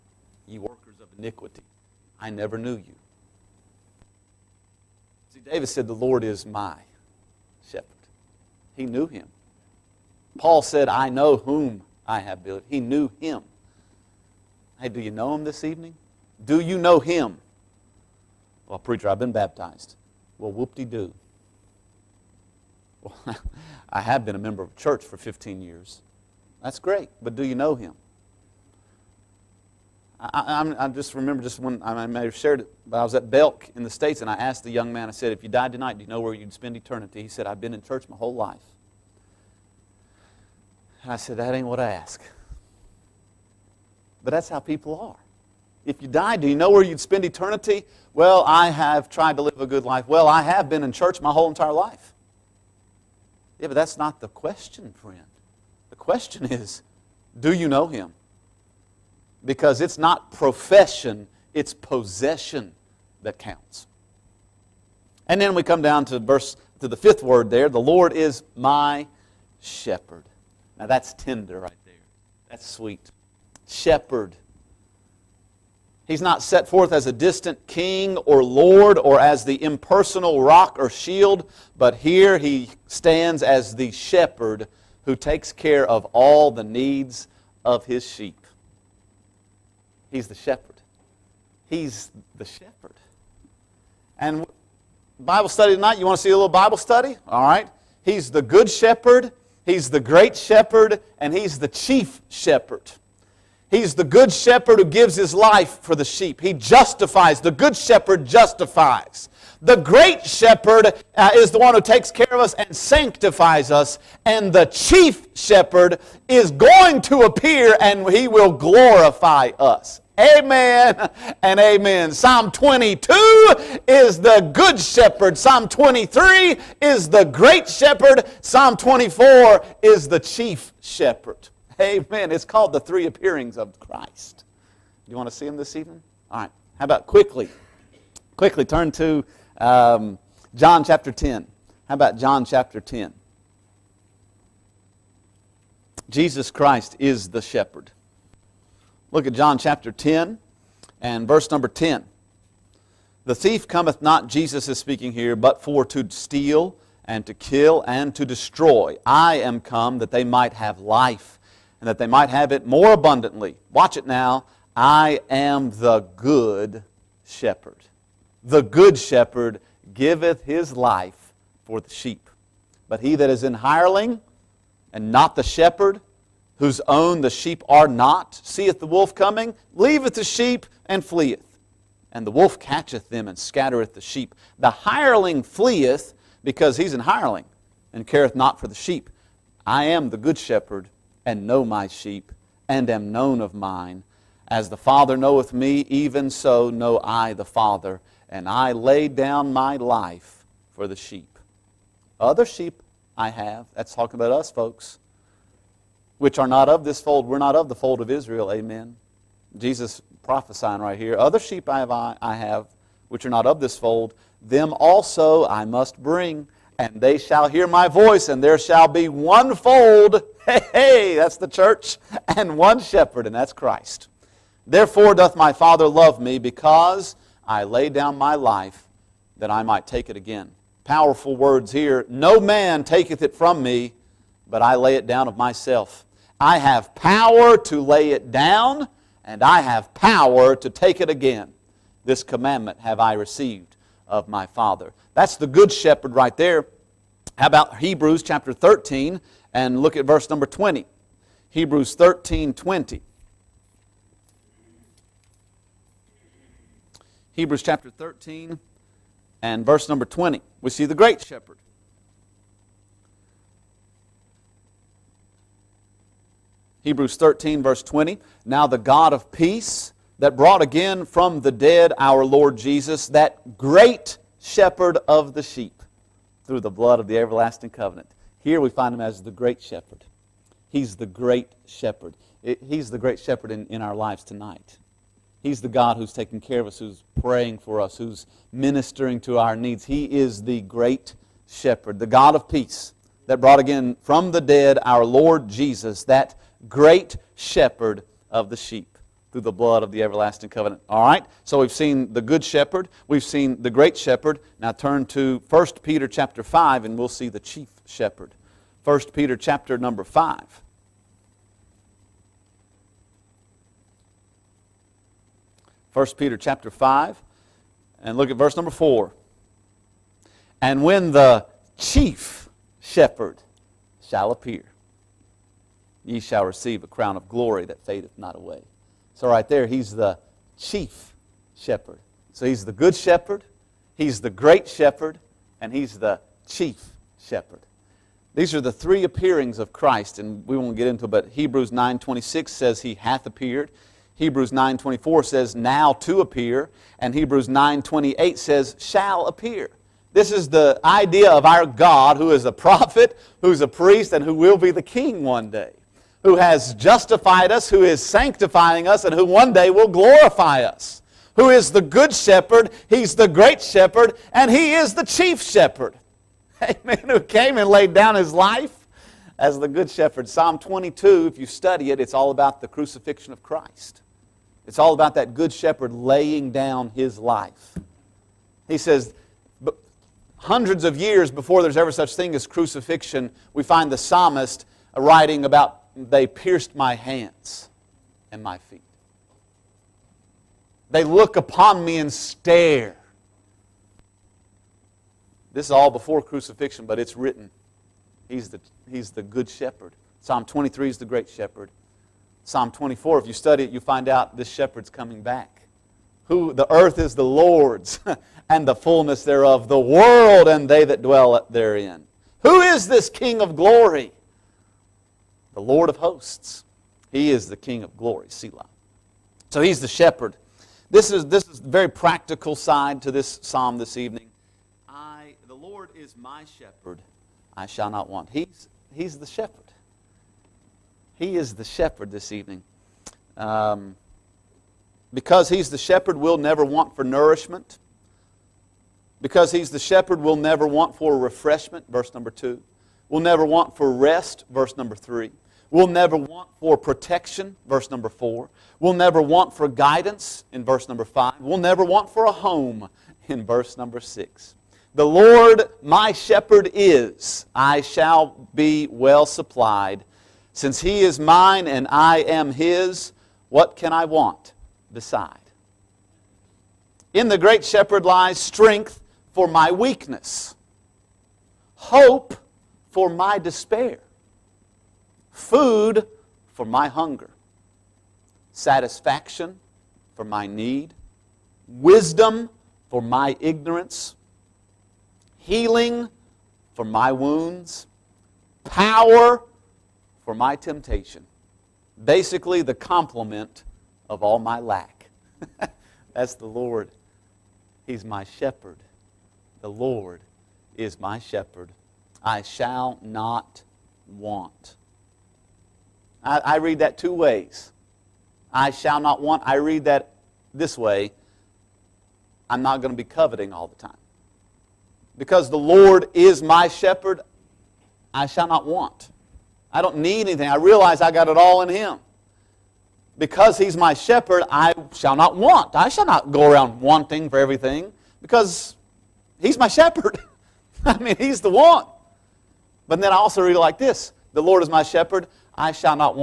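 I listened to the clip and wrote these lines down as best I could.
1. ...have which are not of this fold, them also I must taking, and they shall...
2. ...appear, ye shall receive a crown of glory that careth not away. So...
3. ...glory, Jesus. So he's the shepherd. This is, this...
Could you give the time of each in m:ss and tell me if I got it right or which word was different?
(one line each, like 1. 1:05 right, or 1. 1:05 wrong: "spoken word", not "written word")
1. 3:32 wrong: "bring", not "taking"
2. 5:24 wrong: "fadeth", not "careth"
3. 6:57 wrong: "Selah", not "Jesus".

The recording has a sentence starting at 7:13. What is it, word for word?
Um, because he's the shepherd, we'll never want for nourishment.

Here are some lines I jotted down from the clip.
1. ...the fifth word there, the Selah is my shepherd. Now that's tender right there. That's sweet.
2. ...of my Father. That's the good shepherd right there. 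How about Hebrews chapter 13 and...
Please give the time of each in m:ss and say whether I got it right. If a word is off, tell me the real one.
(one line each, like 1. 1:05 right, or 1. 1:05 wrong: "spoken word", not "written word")
1. 1:06 wrong: "Lord", not "Selah"
2. 4:04 right.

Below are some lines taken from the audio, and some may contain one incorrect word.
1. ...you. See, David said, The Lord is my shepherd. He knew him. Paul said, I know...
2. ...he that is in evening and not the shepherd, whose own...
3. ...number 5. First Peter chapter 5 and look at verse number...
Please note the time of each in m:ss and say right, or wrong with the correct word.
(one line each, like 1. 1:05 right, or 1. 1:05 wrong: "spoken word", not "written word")
1. 0:02 right
2. 2:53 wrong: "hireling", not "evening"
3. 5:09 right.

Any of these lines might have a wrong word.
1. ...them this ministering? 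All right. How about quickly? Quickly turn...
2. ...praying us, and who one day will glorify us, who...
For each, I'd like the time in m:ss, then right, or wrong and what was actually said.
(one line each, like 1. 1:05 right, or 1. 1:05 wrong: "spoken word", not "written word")
1. 2:15 wrong: "evening", not "ministering"
2. 5:58 wrong: "sanctifying", not "praying".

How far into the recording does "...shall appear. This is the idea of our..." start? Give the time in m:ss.
5:48.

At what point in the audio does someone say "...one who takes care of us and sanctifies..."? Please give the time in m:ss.
1:51.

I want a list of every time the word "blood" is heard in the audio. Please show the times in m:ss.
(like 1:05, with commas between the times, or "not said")
4:36, 4:59.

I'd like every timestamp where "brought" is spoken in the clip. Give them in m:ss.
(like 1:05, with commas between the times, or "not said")
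4:30, 4:53.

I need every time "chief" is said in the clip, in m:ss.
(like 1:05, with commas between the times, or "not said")
1:41, 1:54, 2:10, 5:07, 5:21, 5:30, 5:36, 6:05.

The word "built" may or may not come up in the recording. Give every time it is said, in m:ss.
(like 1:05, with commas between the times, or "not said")
0:12.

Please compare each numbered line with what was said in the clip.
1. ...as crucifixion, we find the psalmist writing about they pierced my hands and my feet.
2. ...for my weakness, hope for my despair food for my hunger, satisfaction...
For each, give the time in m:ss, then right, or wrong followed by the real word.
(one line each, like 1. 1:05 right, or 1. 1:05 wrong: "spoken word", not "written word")
1. 6:22 right
2. 7:49 right.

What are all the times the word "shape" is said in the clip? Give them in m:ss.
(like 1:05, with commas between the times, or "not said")
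not said.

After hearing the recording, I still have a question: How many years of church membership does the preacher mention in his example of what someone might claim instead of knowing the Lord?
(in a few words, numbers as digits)
15.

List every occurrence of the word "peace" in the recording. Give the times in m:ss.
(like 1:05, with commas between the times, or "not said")
4:29, 4:52.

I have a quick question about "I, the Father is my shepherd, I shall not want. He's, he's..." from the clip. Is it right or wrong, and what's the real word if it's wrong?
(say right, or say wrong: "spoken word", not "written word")
wrong: "Lord", not "Father".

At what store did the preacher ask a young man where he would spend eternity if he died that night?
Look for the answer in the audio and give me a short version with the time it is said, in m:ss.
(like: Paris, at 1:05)
Belk, at 0:33.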